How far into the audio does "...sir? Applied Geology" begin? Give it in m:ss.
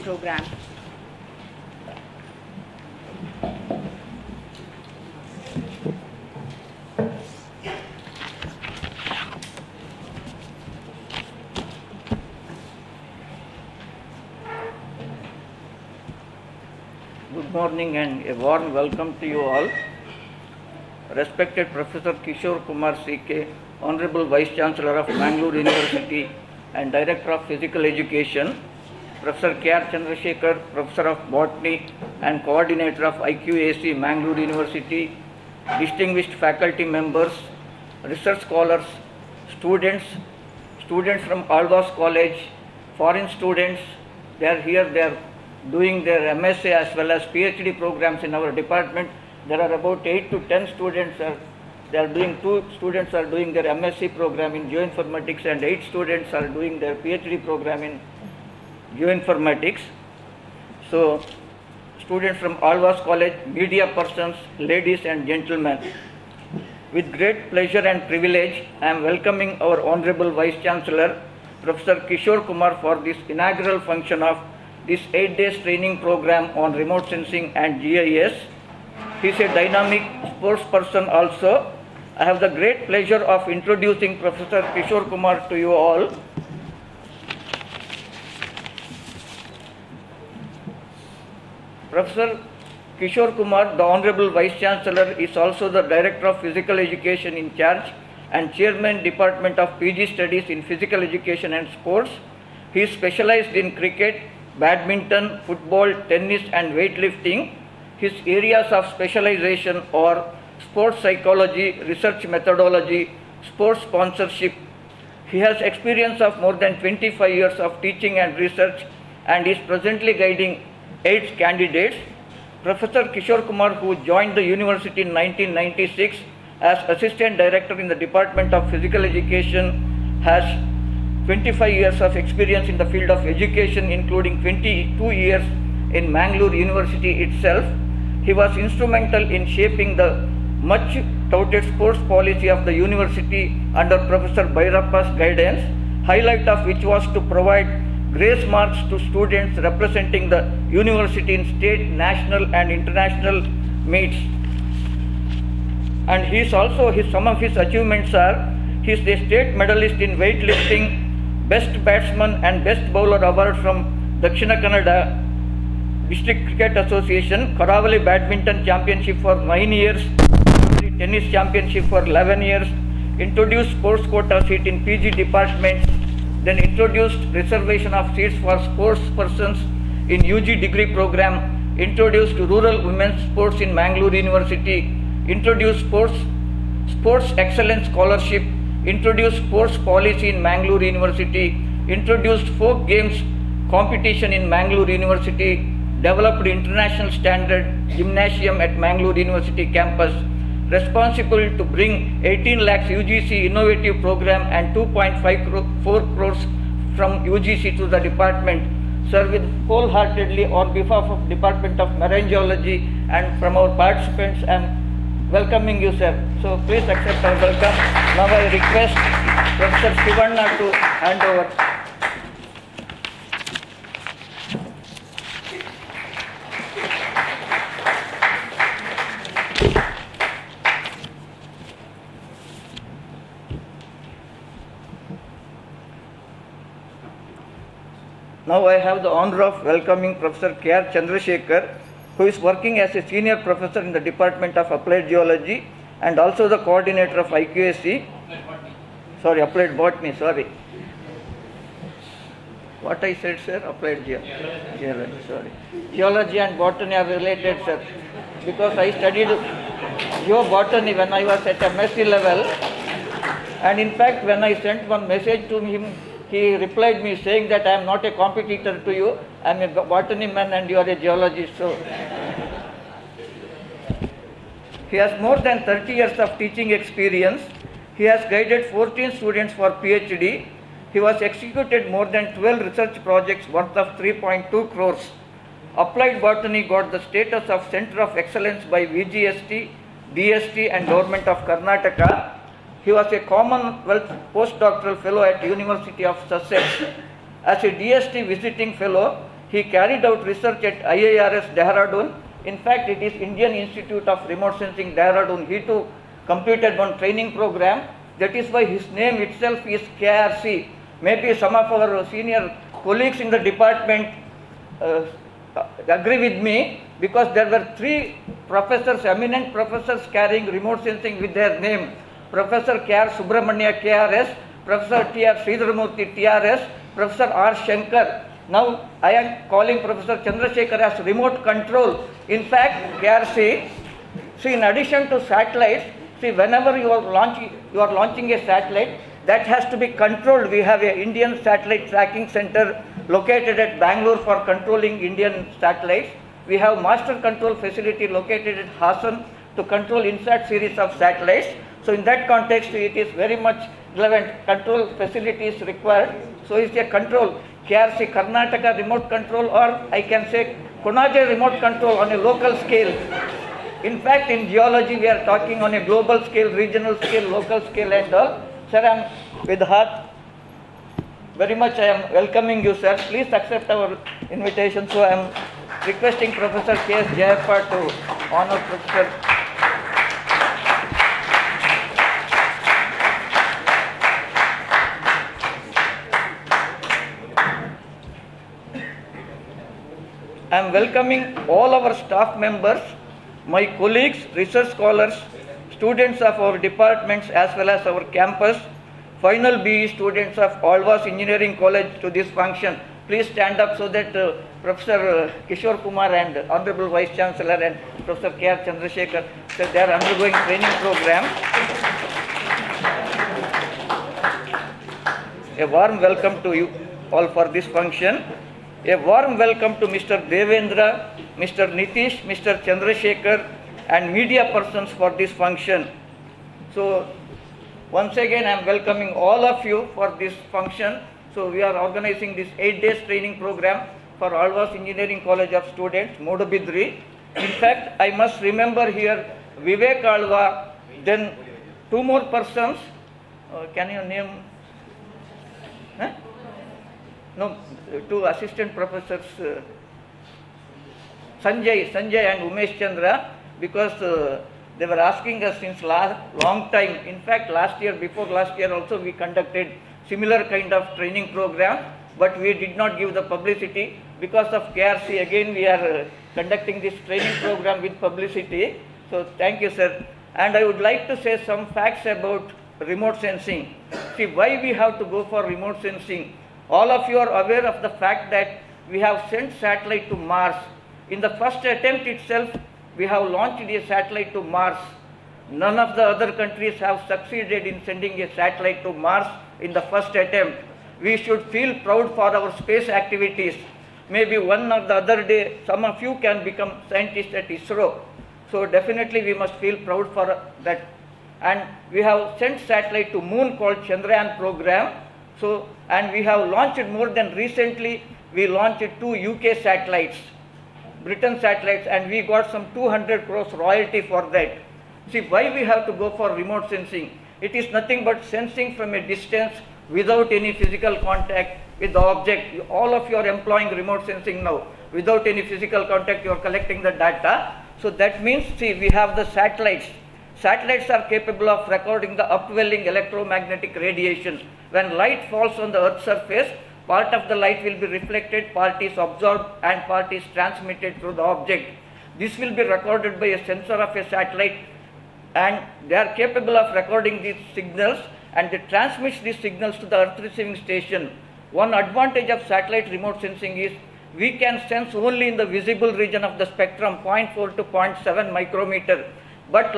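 4:13.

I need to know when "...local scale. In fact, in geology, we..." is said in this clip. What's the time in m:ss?
6:02.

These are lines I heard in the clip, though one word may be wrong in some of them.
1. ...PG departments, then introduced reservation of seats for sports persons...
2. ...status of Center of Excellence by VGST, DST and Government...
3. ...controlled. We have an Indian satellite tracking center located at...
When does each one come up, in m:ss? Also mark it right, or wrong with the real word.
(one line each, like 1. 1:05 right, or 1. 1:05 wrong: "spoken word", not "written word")
1. 2:54 right
2. 4:47 right
3. 5:40 right.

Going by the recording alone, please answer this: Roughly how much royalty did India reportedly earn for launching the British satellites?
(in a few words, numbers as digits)
200 crores.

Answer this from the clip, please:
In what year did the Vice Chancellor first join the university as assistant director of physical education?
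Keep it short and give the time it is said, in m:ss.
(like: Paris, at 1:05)
1996, at 2:05.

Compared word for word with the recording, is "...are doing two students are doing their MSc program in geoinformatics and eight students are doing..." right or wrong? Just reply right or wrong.
right.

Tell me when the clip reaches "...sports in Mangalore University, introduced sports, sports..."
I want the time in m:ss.
3:03.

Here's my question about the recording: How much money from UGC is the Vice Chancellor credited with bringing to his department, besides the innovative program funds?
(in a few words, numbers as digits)
2.54 crores.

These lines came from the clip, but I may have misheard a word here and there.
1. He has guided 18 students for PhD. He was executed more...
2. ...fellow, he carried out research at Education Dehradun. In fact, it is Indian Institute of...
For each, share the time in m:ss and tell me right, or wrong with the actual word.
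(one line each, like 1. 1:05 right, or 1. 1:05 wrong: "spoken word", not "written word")
1. 4:37 wrong: "14", not "18"
2. 4:58 wrong: "IIRS", not "Education".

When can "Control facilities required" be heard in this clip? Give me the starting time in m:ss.
5:54.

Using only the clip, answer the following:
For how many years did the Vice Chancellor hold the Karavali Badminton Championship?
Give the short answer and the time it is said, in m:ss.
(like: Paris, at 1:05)
9, at 2:49.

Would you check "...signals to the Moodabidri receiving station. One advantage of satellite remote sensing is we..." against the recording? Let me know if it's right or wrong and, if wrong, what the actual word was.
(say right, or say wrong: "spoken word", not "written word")
wrong: "Earth", not "Moodabidri".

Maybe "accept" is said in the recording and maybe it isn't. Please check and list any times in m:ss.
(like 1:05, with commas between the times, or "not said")
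3:36, 6:13.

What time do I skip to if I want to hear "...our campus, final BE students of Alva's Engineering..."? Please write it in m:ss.
6:37.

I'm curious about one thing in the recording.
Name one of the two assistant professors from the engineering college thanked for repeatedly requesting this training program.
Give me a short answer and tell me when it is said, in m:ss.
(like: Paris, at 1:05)
Umesh Chandra, at 7:32.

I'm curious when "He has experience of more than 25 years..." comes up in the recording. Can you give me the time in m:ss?
1:55.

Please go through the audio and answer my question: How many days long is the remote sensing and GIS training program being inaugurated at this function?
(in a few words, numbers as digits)
8.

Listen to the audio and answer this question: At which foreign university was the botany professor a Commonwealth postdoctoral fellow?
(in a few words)
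University of Sussex.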